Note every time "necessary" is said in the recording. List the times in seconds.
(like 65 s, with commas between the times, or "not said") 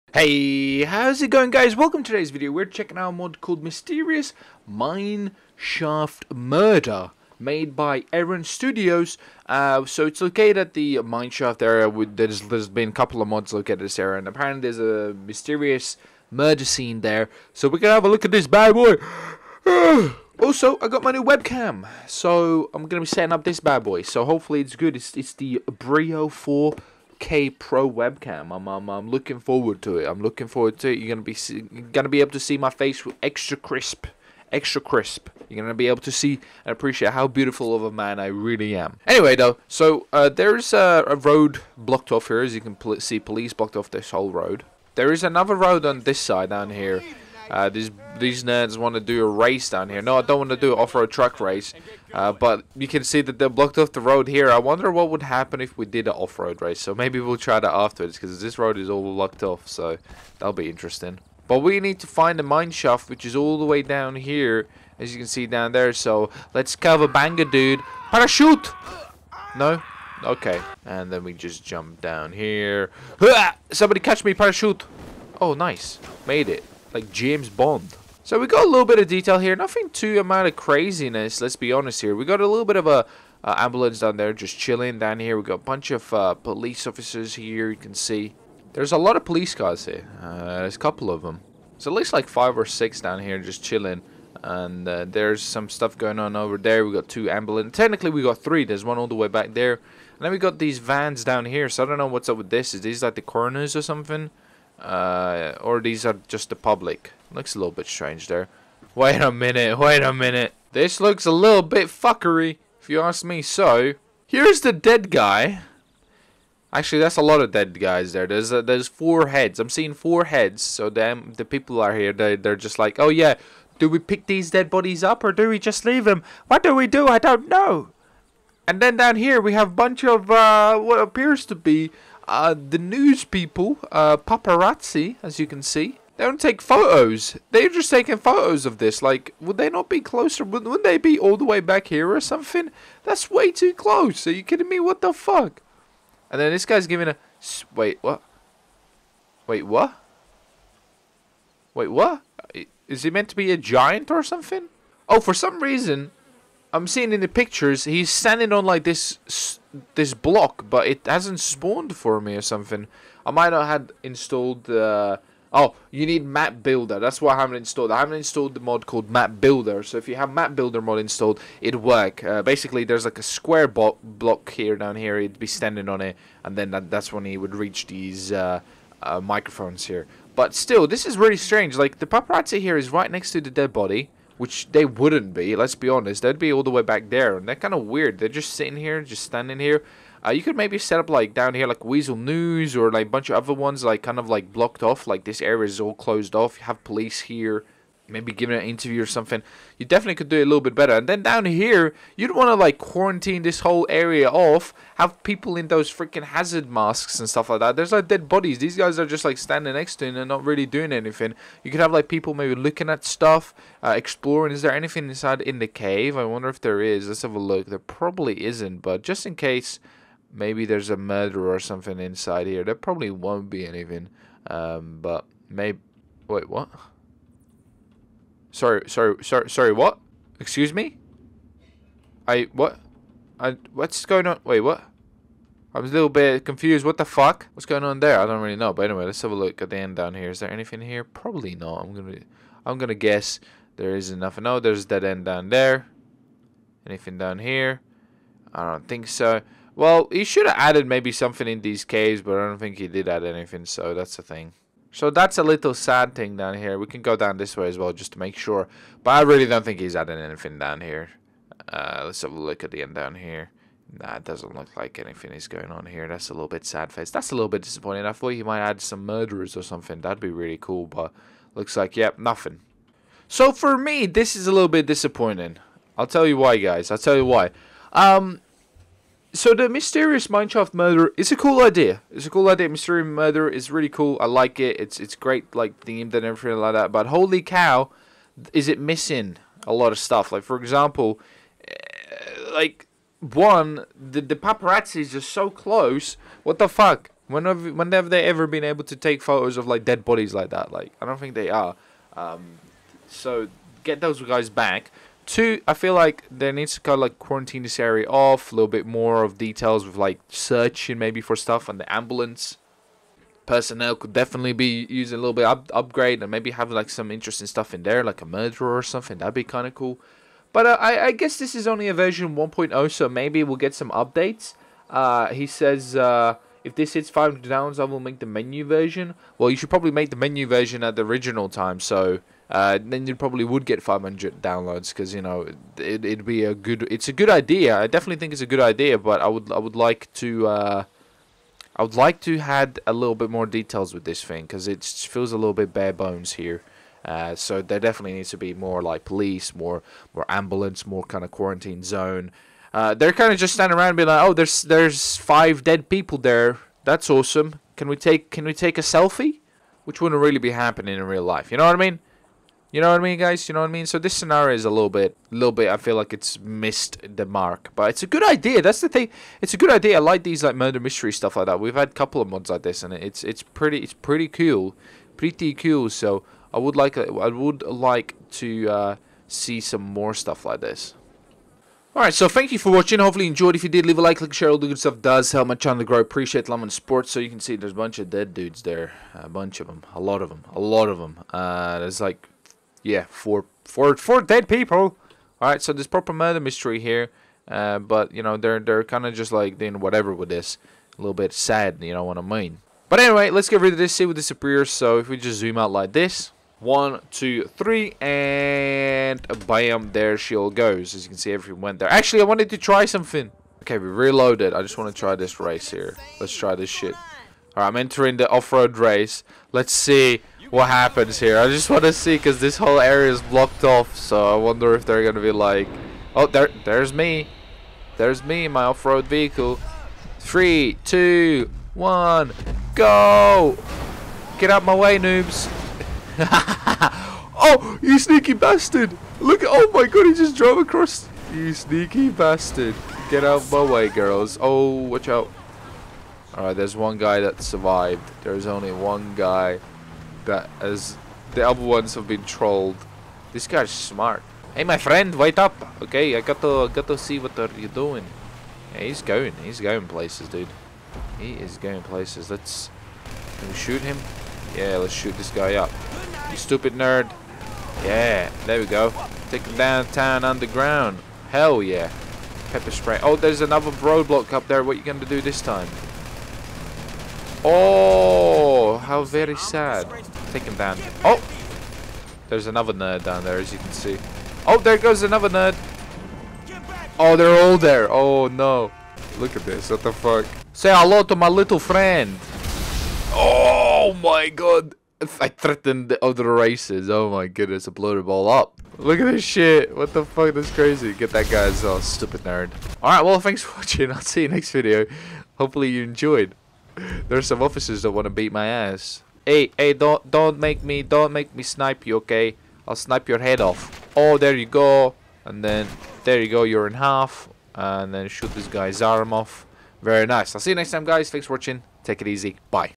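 not said.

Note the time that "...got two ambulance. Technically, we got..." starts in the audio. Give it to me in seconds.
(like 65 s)
96 s.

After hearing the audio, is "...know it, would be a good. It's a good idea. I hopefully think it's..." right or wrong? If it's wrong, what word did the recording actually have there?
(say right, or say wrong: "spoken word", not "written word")
wrong: "definitely", not "hopefully".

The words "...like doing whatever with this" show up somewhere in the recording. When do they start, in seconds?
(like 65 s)
399 s.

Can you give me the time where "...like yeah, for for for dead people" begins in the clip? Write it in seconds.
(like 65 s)
391 s.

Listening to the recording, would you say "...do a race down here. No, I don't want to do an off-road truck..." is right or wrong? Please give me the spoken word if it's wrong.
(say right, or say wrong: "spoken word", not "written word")
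right.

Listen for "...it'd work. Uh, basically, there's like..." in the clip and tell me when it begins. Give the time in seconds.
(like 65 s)
171 s.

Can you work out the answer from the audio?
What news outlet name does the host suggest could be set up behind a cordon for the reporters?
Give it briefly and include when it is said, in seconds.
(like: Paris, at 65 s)
Weasel News, at 191 s.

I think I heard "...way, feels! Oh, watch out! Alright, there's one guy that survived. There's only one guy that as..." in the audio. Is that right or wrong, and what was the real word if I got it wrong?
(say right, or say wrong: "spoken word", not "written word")
wrong: "girls", not "feels".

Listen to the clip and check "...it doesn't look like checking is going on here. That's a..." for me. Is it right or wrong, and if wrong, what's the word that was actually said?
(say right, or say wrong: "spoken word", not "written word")
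wrong: "anything", not "checking".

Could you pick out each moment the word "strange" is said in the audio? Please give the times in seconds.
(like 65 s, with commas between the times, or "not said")
107 s, 181 s.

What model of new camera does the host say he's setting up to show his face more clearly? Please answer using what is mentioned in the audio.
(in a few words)
Brio 4K Pro.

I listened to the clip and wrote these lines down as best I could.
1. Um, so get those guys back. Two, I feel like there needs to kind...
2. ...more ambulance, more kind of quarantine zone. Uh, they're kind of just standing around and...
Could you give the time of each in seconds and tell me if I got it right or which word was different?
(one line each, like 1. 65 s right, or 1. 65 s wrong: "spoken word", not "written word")
1. 302 s right
2. 350 s right.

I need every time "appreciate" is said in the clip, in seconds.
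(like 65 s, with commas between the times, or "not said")
36 s, 385 s.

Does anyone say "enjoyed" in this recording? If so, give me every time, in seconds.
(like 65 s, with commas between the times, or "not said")
383 s, 505 s.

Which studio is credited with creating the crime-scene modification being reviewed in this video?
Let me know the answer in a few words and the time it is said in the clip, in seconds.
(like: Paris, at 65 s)
Eren Studios, at 8 s.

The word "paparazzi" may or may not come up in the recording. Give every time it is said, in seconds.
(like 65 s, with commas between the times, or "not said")
134 s, 182 s, 294 s.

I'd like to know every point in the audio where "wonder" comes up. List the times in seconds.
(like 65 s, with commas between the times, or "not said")
54 s, 216 s, 424 s.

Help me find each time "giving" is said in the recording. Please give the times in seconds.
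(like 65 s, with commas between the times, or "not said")
146 s, 198 s.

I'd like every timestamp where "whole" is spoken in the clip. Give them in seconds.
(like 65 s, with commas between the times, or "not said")
44 s, 203 s, 422 s.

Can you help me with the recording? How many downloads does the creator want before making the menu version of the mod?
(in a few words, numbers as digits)
500.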